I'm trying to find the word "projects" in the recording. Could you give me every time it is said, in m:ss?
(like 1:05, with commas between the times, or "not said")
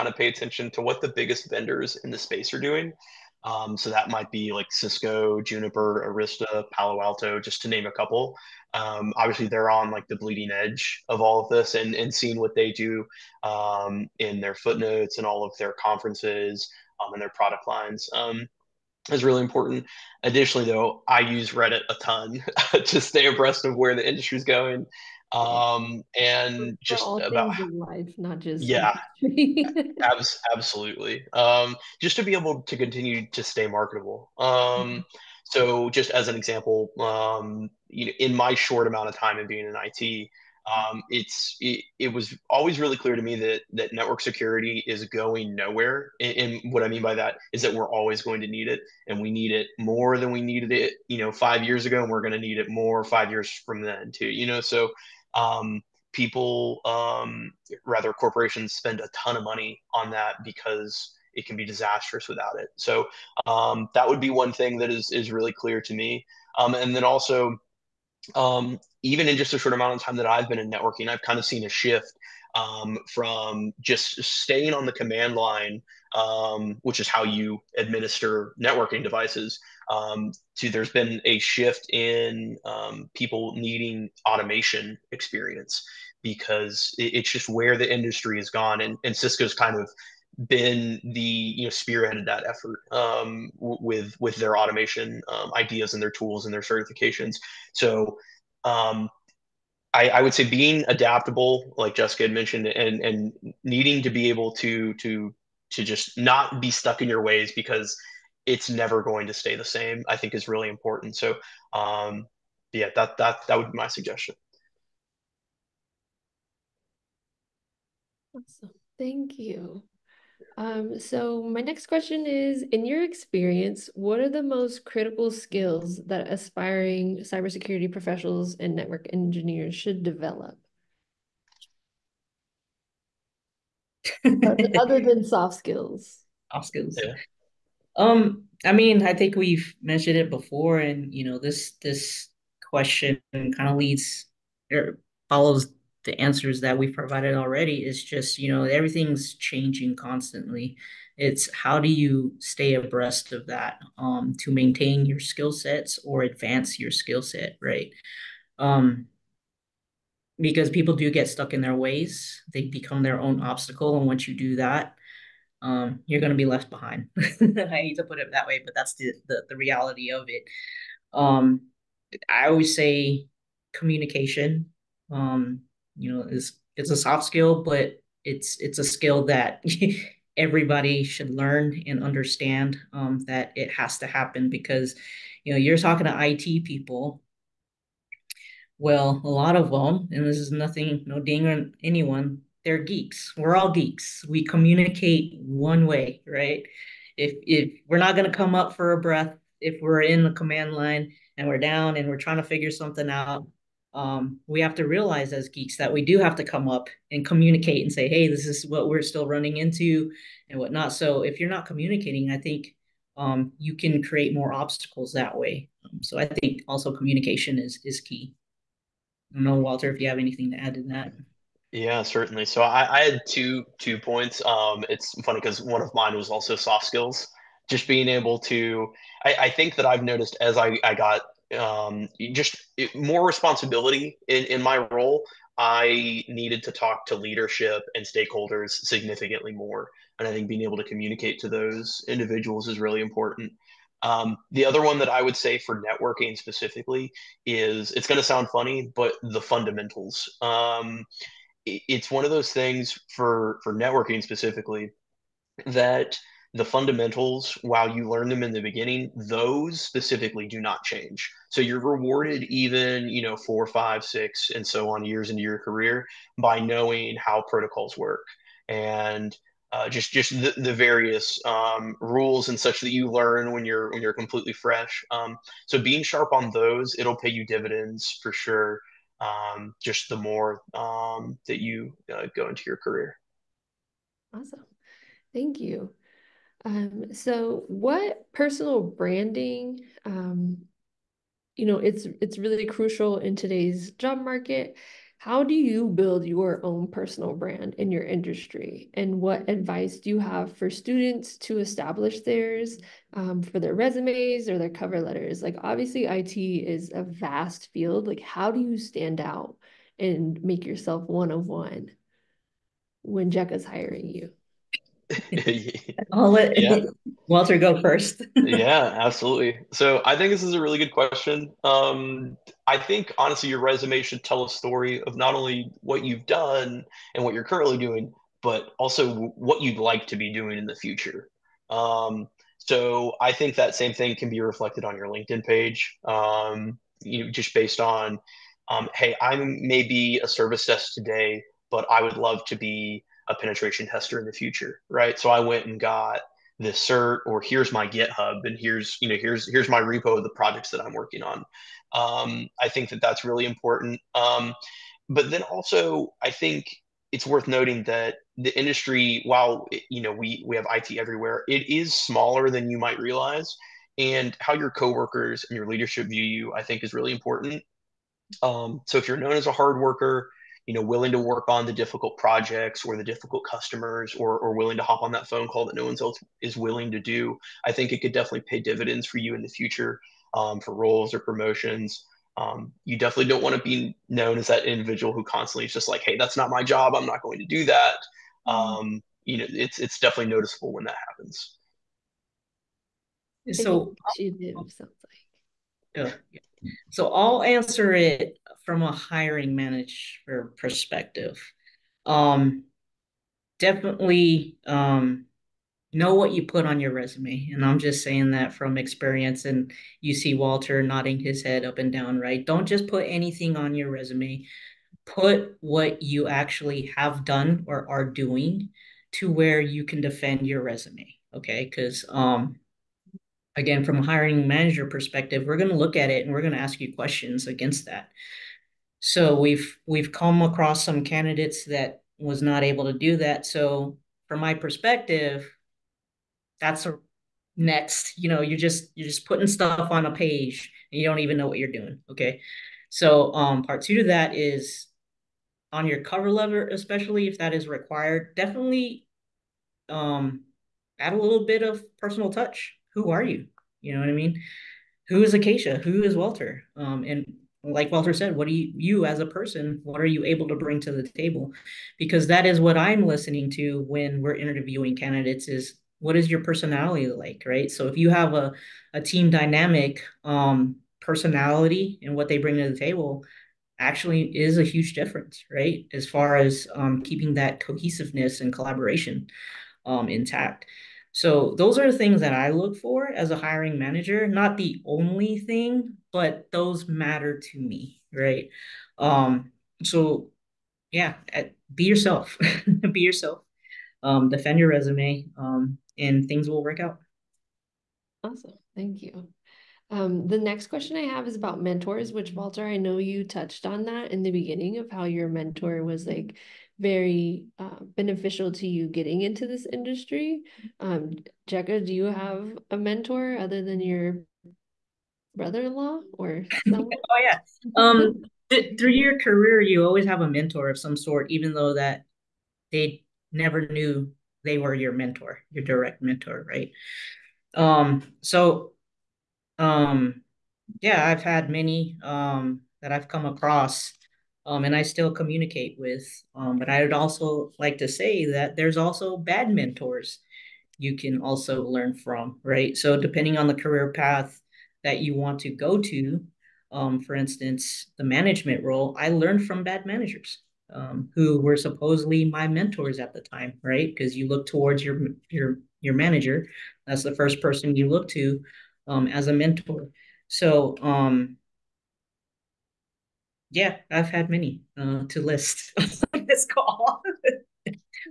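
5:50, 6:12.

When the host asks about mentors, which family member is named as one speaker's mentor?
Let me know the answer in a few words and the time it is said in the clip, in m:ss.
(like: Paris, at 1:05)
Brother-in-law, at 8:35.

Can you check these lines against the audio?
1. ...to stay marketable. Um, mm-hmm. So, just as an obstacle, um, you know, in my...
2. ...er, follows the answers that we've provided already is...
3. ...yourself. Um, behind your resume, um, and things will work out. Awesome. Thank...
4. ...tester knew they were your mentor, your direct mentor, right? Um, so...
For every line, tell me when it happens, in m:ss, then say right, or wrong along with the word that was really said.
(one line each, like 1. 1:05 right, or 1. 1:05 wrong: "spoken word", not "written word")
1. 0:33 wrong: "example", not "obstacle"
2. 2:24 right
3. 8:13 wrong: "defend", not "behind"
4. 8:43 wrong: "never", not "tester".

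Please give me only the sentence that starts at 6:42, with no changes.
Um, definitely um, know what you put on your resume.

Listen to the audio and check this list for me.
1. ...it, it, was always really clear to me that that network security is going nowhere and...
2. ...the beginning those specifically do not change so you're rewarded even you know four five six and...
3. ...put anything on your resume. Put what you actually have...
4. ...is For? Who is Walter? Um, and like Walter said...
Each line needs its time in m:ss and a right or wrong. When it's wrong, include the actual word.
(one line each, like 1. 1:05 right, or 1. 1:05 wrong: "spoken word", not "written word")
1. 0:41 right
2. 4:18 right
3. 6:52 right
4. 7:35 wrong: "Acacia", not "For".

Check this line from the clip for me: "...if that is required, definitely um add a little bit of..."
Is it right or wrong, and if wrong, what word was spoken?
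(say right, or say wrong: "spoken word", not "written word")
right.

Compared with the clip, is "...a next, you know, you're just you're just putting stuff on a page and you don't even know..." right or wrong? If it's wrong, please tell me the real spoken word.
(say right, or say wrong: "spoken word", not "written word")
right.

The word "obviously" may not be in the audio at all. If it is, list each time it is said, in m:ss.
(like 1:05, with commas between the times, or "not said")
0:09, 5:05.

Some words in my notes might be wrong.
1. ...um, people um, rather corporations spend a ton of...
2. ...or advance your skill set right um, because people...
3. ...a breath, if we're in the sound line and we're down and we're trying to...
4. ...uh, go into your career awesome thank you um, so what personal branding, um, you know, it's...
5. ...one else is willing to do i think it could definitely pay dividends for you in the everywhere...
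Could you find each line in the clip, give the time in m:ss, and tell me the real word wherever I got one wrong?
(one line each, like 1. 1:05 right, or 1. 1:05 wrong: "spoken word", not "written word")
1. 0:55 right
2. 2:36 right
3. 3:18 wrong: "command", not "sound"
4. 4:42 right
5. 6:15 wrong: "future", not "everywhere".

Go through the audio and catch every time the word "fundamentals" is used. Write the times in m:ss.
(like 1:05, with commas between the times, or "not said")
4:09, 4:16.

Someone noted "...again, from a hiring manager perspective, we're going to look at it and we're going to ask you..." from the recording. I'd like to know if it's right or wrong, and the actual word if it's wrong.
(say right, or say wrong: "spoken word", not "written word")
right.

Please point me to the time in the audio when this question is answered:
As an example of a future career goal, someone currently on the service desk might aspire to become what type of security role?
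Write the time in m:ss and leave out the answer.
5:43.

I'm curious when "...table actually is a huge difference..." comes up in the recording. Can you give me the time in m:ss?
7:52.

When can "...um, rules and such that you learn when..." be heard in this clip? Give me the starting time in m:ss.
4:31.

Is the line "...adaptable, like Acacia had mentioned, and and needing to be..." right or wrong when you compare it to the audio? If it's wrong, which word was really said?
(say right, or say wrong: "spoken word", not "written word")
wrong: "Jessica", not "Acacia".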